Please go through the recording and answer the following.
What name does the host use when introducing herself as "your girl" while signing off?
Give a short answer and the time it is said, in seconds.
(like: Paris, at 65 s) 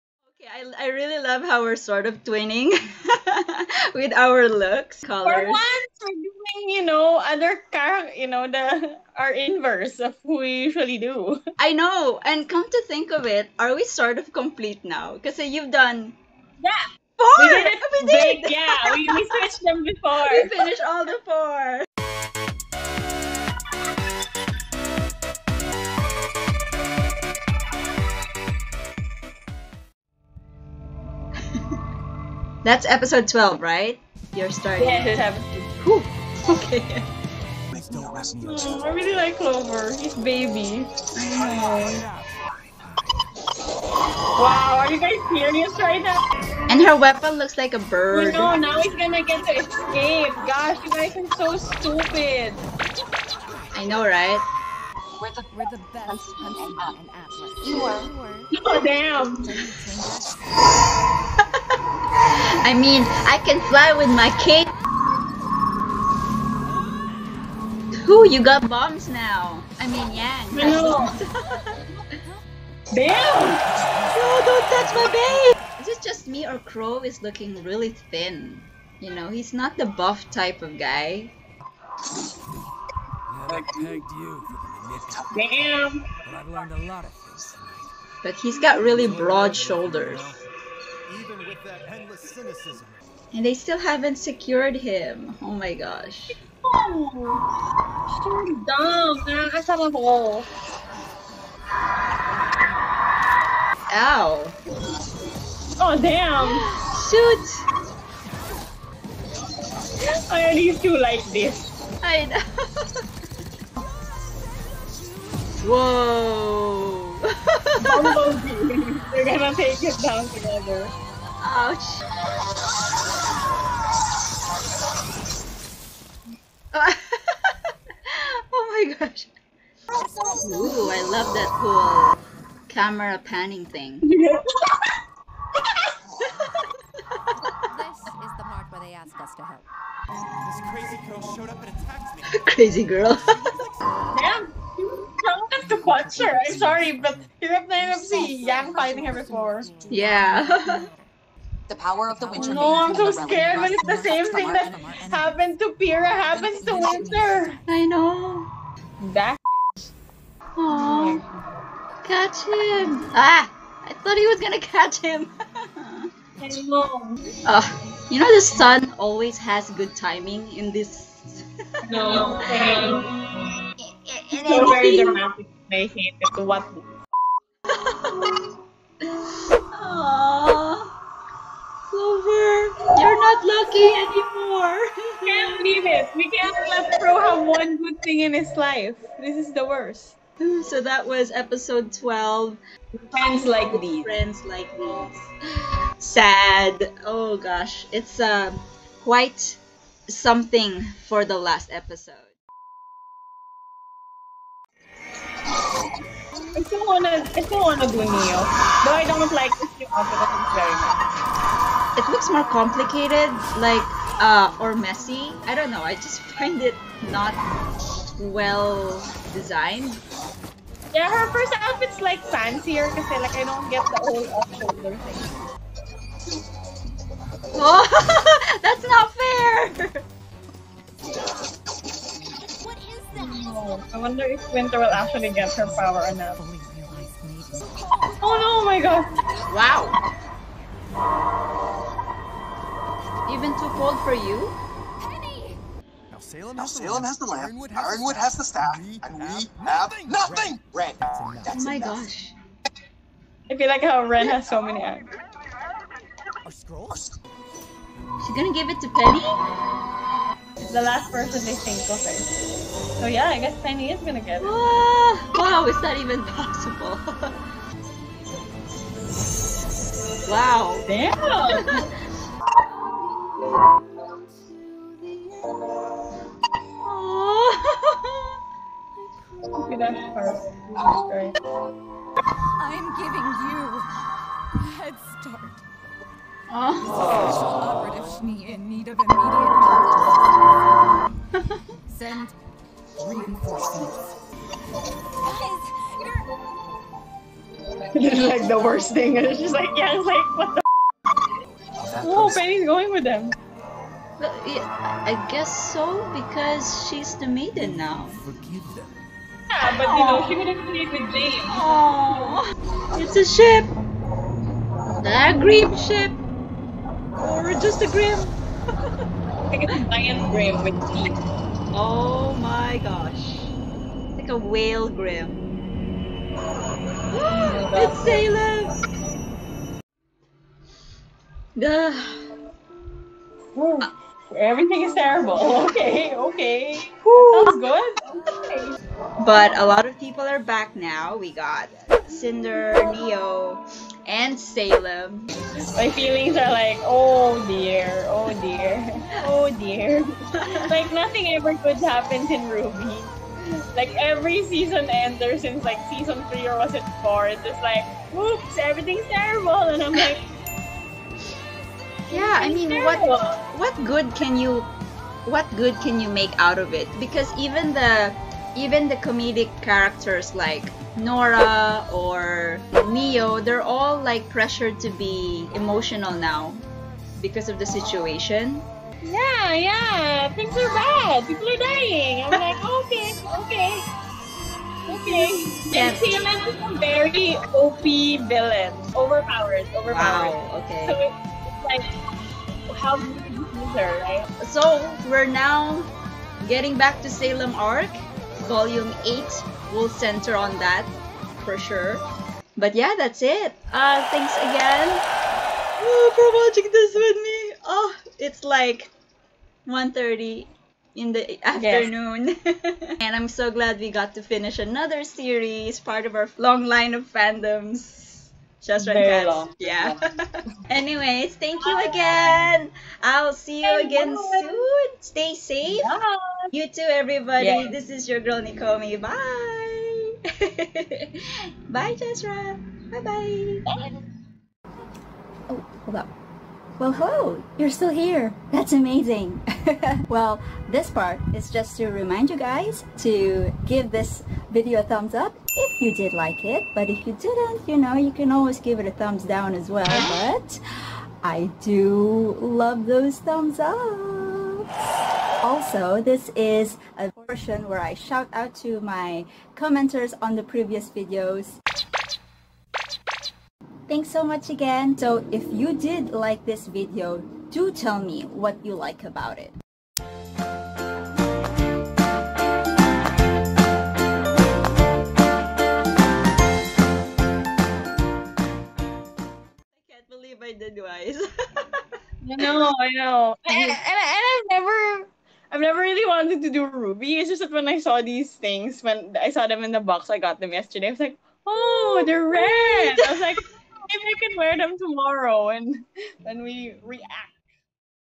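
Nekomi, at 428 s.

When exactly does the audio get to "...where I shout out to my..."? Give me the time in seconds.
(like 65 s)
457 s.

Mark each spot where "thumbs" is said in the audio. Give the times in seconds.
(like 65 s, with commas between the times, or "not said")
444 s, 448 s, 453 s.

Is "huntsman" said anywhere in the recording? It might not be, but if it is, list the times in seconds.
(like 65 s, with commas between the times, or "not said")
56 s.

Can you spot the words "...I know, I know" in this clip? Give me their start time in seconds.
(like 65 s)
482 s.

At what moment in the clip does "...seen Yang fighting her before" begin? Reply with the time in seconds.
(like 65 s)
147 s.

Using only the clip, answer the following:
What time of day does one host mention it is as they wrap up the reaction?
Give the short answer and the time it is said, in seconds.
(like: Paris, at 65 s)
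1:30 in the afternoon, at 409 s.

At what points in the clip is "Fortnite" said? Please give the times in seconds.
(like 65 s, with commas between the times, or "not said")
not said.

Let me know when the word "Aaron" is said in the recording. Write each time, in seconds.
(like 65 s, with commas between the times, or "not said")
not said.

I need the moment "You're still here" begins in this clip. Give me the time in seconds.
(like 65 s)
437 s.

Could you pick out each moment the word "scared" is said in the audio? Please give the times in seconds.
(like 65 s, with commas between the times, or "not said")
153 s.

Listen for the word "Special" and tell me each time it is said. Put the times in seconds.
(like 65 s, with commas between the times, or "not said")
286 s.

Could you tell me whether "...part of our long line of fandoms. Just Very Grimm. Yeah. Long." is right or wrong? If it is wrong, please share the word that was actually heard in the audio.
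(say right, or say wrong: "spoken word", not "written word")
wrong: "Long", not "Grimm".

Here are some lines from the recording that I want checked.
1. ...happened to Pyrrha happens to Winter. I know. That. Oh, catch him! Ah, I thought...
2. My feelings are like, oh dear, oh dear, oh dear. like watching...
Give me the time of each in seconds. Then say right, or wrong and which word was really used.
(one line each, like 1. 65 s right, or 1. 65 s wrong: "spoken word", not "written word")
1. 155 s right
2. 345 s wrong: "nothing", not "watching".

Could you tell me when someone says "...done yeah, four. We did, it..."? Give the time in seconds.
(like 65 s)
15 s.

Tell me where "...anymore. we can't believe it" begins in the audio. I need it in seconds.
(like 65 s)
183 s.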